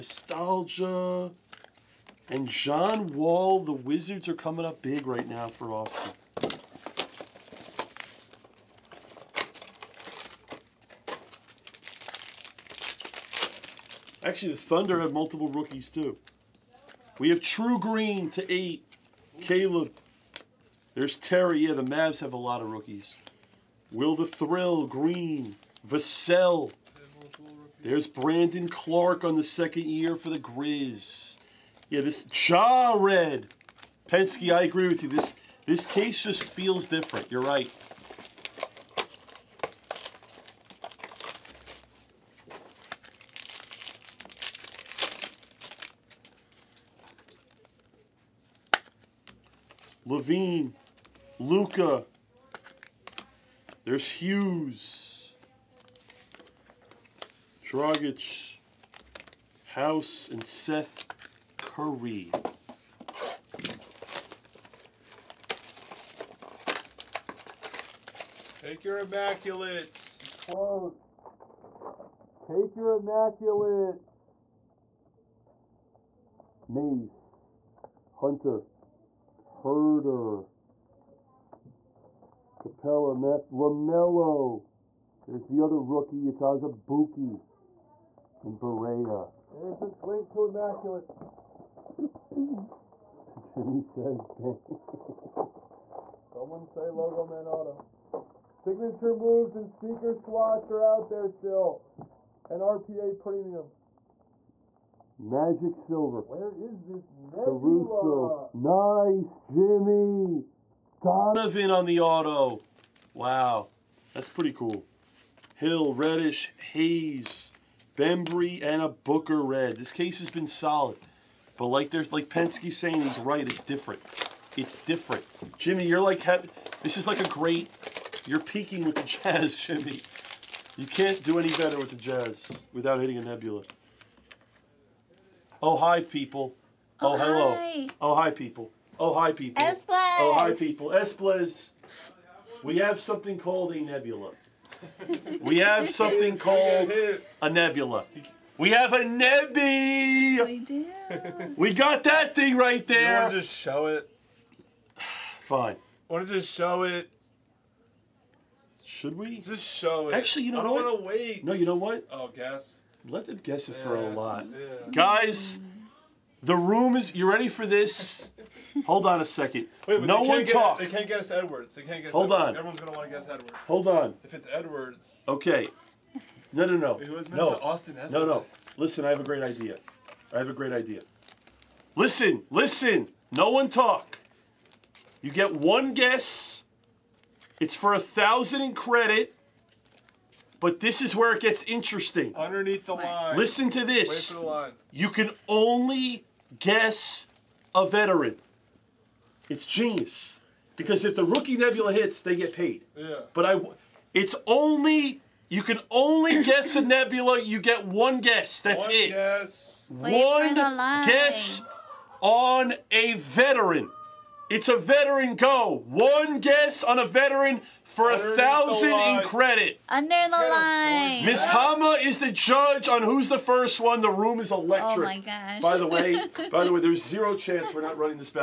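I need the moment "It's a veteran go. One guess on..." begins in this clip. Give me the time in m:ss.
3:34.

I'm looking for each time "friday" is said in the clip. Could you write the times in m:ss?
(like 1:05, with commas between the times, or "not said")
not said.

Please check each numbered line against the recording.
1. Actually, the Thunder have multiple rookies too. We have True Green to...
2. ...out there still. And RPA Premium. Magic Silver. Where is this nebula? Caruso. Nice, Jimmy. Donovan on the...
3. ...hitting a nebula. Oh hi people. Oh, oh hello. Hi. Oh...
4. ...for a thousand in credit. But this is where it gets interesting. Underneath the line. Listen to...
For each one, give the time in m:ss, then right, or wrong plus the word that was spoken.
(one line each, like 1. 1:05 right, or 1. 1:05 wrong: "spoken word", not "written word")
1. 0:14 right
2. 1:40 right
3. 2:13 right
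4. 3:07 right.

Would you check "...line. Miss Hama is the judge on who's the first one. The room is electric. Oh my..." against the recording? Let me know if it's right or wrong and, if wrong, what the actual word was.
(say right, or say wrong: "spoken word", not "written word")
right.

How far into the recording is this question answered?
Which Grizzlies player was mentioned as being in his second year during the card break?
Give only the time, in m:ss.
0:28.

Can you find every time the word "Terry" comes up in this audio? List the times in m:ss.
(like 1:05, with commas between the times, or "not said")
0:21.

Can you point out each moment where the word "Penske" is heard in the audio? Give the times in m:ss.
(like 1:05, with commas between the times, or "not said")
0:34, 2:02.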